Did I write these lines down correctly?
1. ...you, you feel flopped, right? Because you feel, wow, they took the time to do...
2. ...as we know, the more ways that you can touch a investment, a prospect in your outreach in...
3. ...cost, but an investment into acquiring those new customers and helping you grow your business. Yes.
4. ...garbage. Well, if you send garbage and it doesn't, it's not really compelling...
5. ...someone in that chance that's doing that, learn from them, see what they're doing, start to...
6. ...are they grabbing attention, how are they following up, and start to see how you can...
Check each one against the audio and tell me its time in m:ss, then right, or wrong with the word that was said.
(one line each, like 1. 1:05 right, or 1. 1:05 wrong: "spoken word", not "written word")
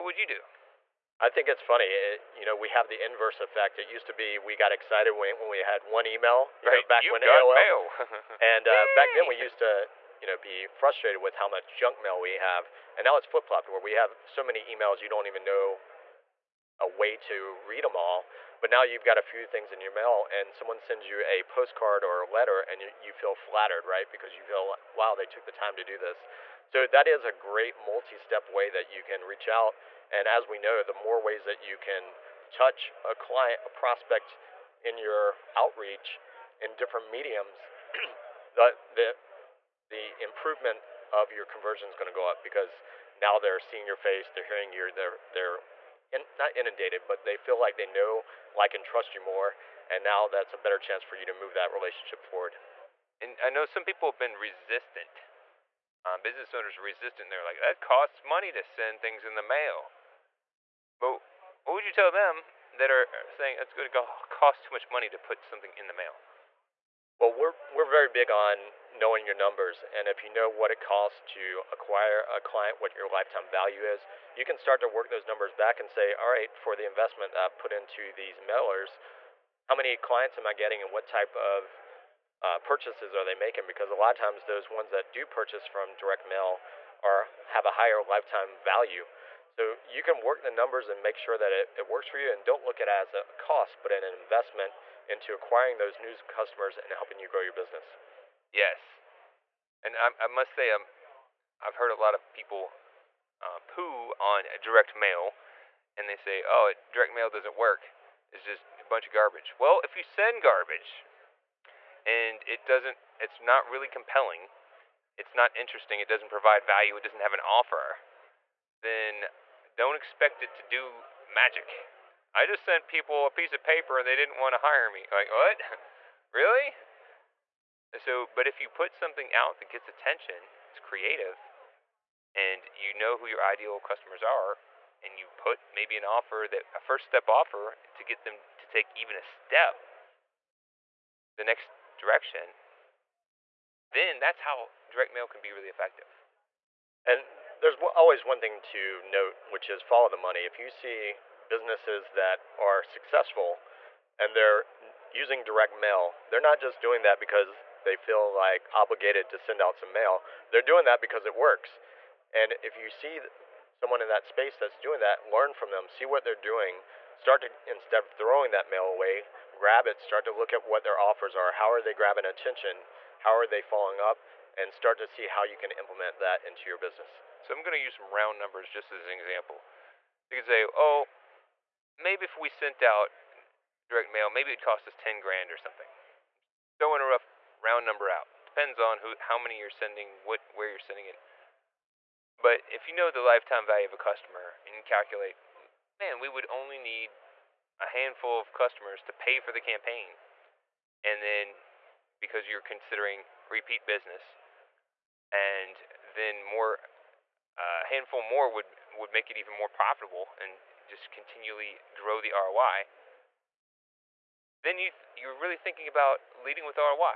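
1. 0:22 wrong: "flattered", not "flopped"
2. 0:30 wrong: "client", not "investment"
3. 1:33 right
4. 1:49 right
5. 2:43 wrong: "space", not "chance"
6. 2:51 right.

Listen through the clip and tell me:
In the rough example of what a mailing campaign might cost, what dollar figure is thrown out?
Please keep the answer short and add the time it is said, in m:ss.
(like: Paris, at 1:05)
$10,000, at 3:04.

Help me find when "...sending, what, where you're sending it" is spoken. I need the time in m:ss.
3:09.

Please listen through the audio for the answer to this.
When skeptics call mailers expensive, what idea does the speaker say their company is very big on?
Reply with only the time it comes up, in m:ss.
1:08.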